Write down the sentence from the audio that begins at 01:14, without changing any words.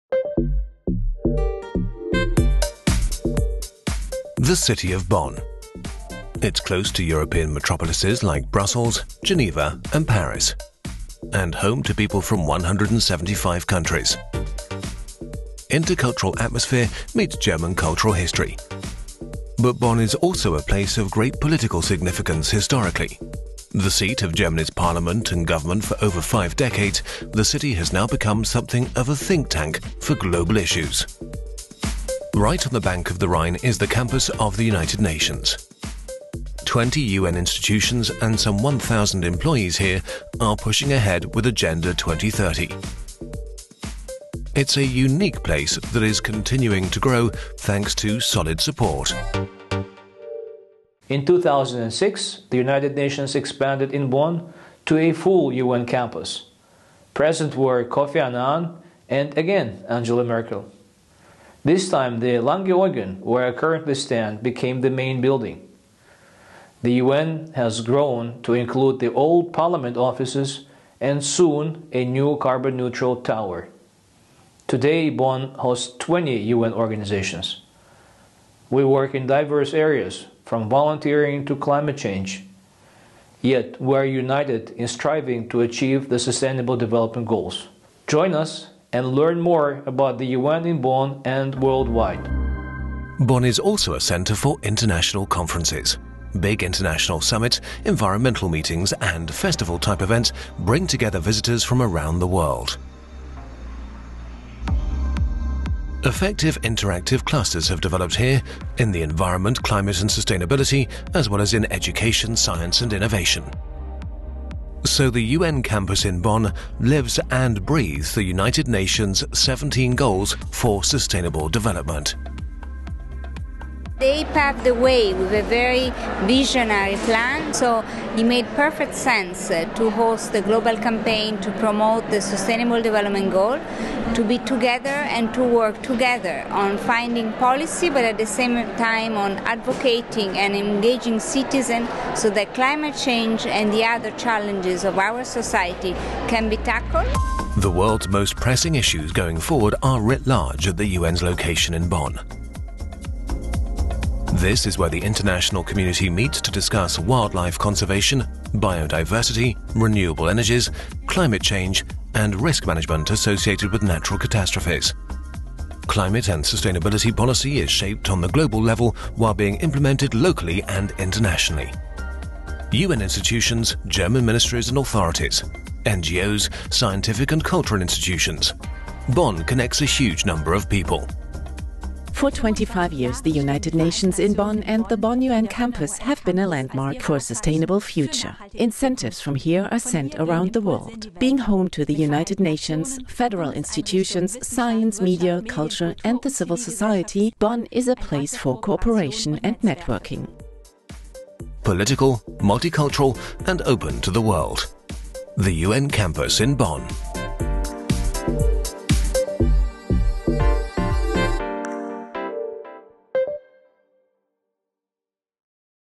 Today, Bonn hosts 20 UN organizations.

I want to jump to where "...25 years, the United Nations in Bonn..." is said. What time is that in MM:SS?
03:02.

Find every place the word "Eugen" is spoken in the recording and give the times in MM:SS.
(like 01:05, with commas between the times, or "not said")
01:02.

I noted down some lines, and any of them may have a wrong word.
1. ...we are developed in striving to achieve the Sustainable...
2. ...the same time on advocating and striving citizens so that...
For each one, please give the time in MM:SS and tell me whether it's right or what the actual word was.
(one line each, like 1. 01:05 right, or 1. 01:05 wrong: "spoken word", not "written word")
1. 01:23 wrong: "united", not "developed"
2. 02:18 wrong: "engaging", not "striving".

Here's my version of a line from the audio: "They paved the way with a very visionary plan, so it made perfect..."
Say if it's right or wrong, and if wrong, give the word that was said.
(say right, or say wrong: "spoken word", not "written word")
right.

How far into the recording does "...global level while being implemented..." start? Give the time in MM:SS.
02:48.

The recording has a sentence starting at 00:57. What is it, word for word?
Present were Kofi Annan and again Angela Merkel.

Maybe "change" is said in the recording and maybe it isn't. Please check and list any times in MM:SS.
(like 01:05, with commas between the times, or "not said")
01:21, 02:22, 02:41.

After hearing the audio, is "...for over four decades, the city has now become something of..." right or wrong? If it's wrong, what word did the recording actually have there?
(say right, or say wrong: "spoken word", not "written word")
wrong: "five", not "four".